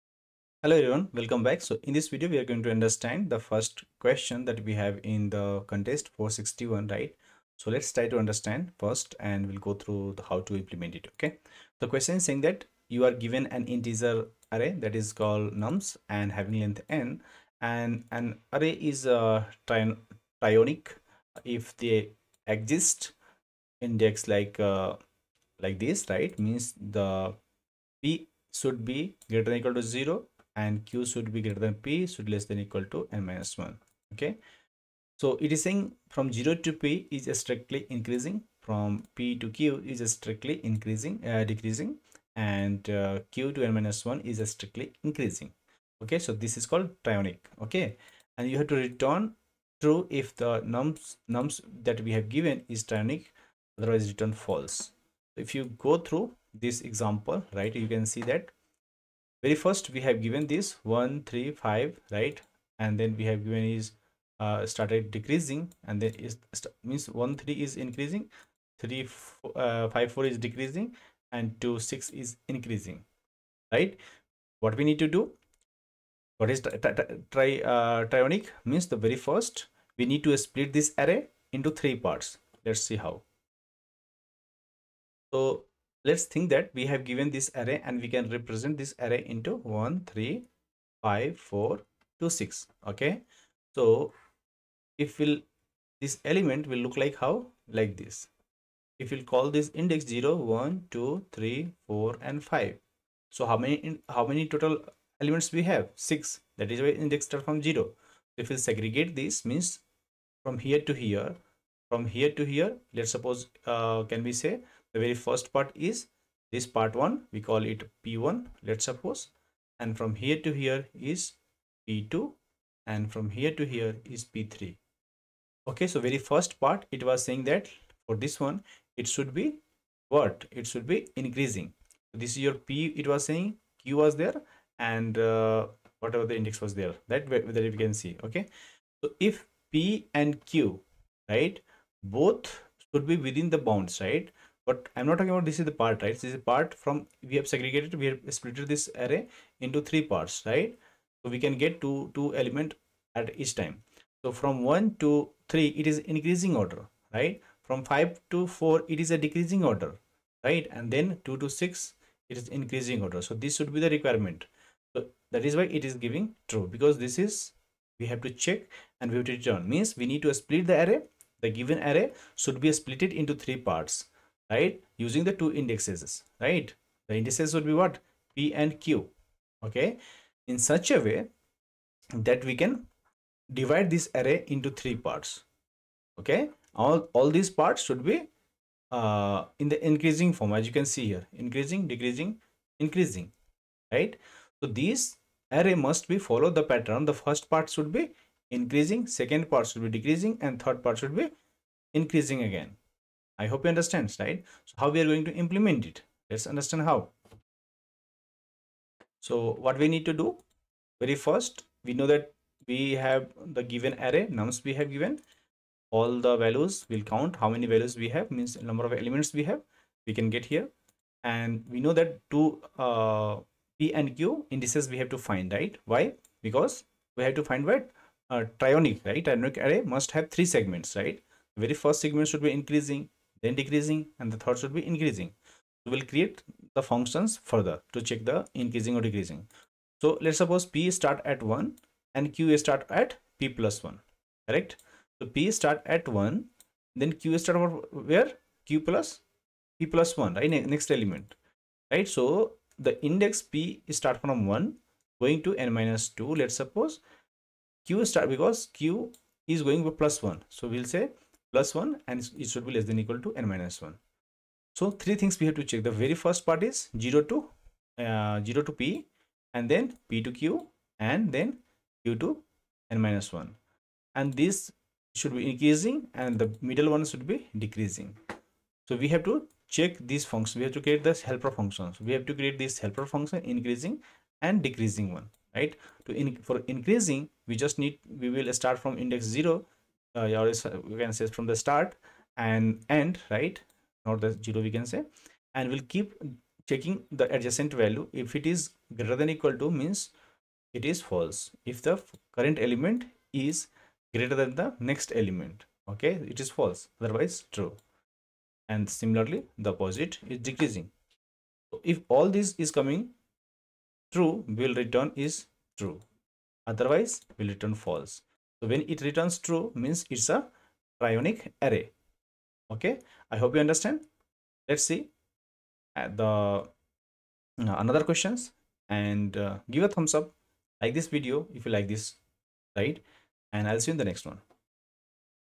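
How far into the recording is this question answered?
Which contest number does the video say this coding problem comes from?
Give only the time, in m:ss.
0:05.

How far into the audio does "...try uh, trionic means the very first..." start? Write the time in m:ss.
1:16.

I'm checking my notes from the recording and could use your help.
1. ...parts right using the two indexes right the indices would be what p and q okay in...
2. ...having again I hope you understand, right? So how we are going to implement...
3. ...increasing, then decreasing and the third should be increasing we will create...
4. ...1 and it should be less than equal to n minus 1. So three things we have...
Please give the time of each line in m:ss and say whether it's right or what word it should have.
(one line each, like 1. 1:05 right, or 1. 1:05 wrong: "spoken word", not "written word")
1. 2:53 right
2. 3:22 wrong: "increasing", not "having"
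3. 3:52 right
4. 4:21 right.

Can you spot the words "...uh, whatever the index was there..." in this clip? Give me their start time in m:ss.
2:15.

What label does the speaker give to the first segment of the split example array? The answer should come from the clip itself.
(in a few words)
p1.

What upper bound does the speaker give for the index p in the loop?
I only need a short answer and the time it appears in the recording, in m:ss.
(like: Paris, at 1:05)
n minus 2, at 4:15.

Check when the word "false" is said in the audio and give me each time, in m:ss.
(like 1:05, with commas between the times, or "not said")
0:54, 5:01, 5:06, 5:17.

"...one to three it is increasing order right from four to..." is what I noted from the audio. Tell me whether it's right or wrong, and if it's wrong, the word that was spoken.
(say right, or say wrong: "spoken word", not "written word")
wrong: "five", not "four".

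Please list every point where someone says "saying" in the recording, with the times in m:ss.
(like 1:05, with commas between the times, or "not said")
0:12, 0:35, 2:07, 2:13.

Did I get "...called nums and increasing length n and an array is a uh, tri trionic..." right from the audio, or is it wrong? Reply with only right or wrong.
wrong.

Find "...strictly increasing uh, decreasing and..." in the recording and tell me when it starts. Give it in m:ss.
0:40.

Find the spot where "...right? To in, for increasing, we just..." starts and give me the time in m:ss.
4:45.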